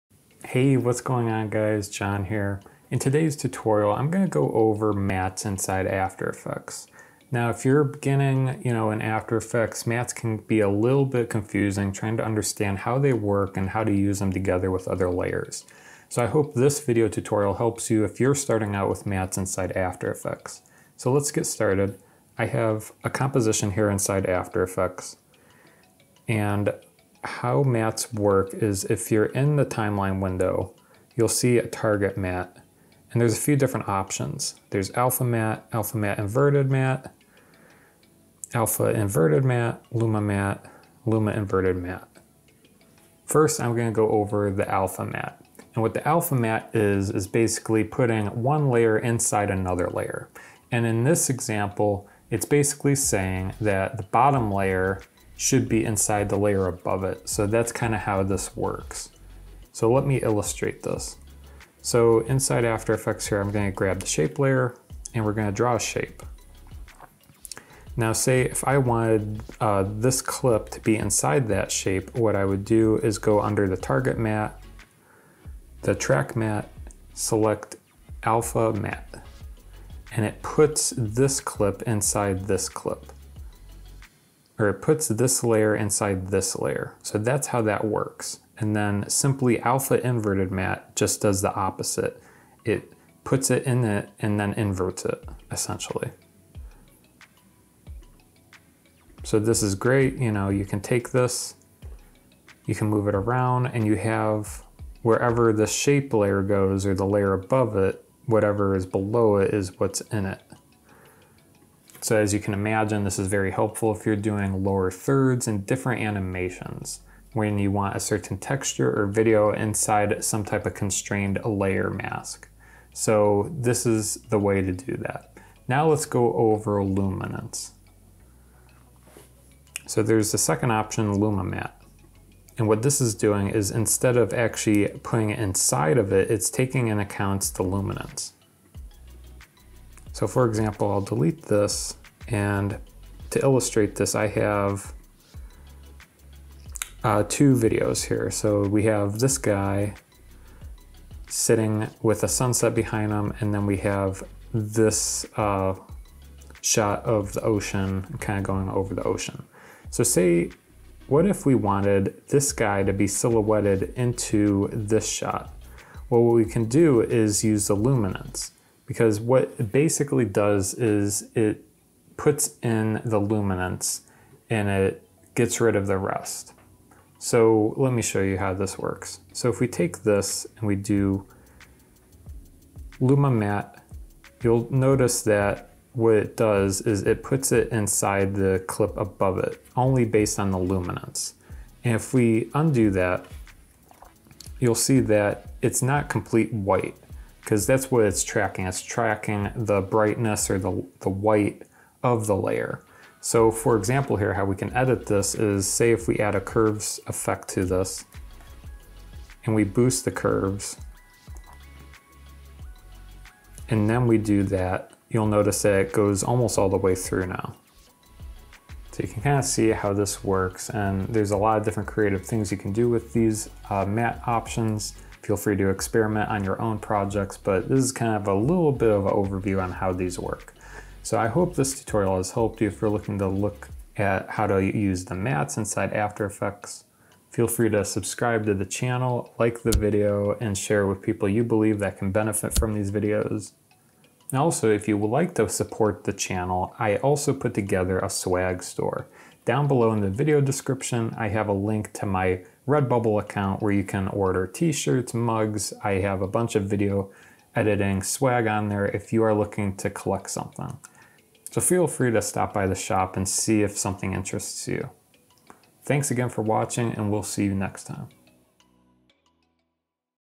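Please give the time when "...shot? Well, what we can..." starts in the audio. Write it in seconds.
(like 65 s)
165 s.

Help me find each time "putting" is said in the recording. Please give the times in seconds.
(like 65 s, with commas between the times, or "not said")
47 s, 135 s.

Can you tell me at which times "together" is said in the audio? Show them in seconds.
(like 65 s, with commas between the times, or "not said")
14 s, 247 s.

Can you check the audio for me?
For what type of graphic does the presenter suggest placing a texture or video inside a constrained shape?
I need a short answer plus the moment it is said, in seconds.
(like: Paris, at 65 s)
Lower thirds, at 114 s.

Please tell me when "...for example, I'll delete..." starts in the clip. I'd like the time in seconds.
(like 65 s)
140 s.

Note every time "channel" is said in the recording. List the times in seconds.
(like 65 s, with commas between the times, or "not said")
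238 s, 246 s.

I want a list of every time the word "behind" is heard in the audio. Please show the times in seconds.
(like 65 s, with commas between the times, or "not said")
152 s.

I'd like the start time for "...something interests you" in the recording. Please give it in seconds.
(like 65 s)
263 s.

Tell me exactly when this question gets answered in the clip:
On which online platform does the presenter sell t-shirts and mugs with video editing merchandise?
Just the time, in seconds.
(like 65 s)
252 s.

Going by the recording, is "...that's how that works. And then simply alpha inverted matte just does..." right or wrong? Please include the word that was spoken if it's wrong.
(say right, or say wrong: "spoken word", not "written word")
right.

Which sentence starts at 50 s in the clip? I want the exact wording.
And in this example, it's basically saying that the bottom layer should be inside the layer above it.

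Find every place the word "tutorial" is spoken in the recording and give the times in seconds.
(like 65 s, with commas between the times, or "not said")
3 s, 17 s, 231 s.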